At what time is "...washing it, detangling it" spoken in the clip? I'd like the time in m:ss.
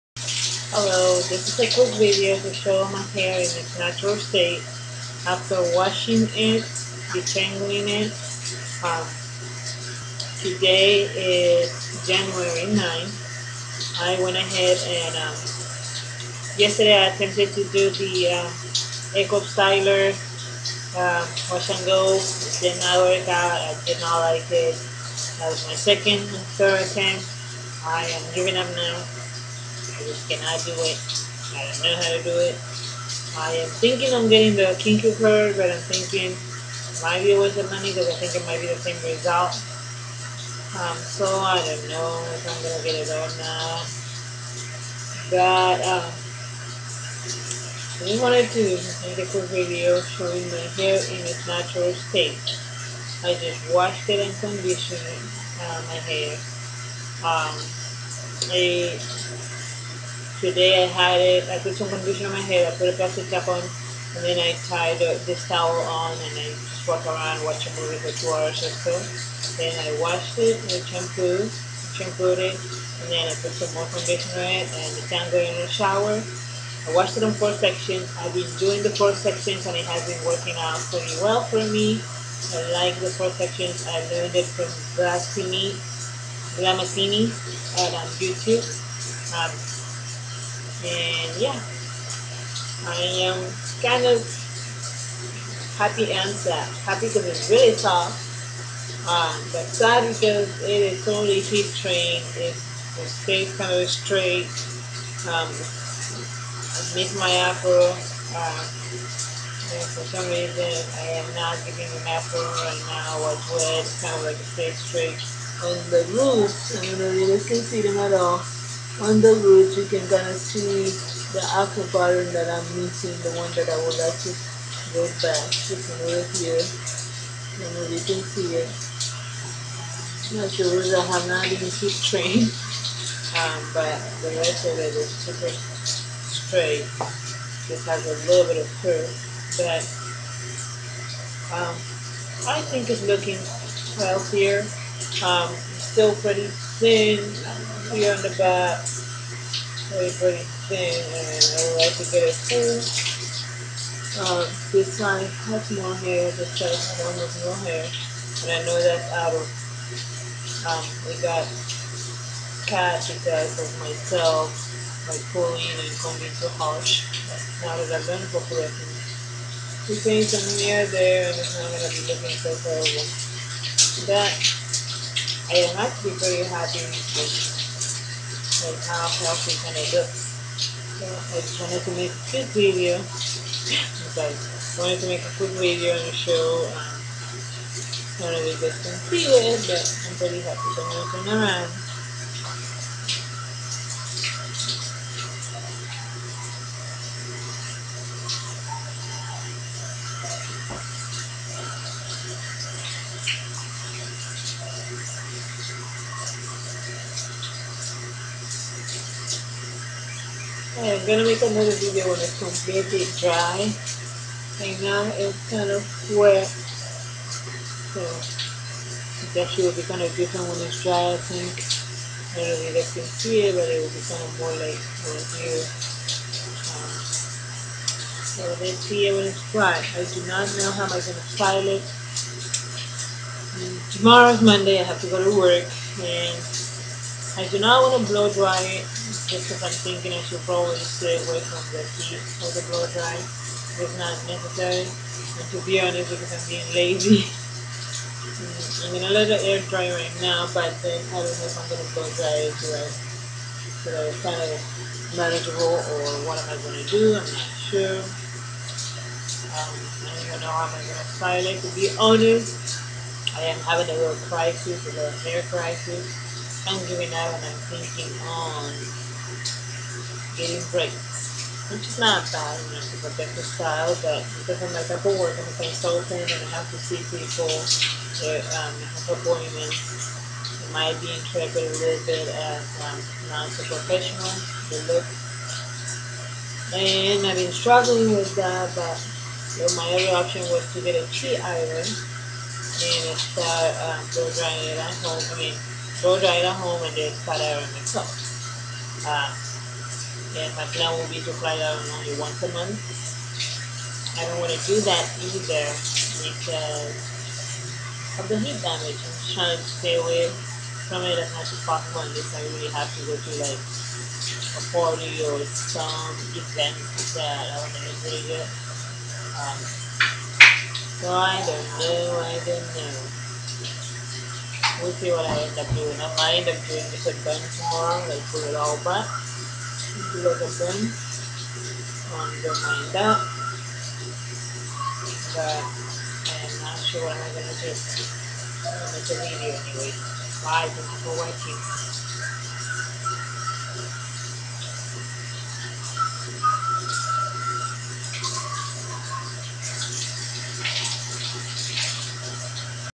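0:05.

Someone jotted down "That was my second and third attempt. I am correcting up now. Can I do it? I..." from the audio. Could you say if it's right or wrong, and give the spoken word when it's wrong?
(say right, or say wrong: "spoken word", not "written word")
wrong: "giving", not "correcting".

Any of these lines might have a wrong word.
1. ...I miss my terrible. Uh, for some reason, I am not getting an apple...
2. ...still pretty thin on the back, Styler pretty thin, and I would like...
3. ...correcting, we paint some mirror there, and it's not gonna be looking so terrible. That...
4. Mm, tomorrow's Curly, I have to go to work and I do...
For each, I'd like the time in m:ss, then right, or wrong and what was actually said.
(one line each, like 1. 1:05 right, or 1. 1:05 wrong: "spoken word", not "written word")
1. 1:45 wrong: "apple", not "terrible"
2. 2:25 wrong: "Wait", not "Styler"
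3. 2:48 right
4. 3:53 wrong: "Monday", not "Curly".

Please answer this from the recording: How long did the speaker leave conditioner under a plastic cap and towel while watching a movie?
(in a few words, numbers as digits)
2 hours.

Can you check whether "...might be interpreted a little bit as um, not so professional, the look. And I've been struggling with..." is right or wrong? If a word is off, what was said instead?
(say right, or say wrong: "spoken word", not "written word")
right.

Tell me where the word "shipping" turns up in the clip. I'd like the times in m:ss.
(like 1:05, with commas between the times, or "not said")
not said.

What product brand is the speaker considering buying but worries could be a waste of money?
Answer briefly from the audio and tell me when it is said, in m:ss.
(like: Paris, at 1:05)
Kinky Curly, at 0:34.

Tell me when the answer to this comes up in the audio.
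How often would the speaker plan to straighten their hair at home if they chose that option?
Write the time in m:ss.
5:02.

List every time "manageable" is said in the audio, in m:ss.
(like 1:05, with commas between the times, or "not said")
4:15.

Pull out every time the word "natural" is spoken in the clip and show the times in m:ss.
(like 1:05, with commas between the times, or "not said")
0:03, 0:51.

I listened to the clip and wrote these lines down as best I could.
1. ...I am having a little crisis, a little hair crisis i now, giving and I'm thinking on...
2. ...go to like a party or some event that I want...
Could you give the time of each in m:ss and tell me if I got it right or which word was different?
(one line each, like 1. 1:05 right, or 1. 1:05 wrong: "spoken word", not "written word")
1. 4:23 right
2. 5:13 right.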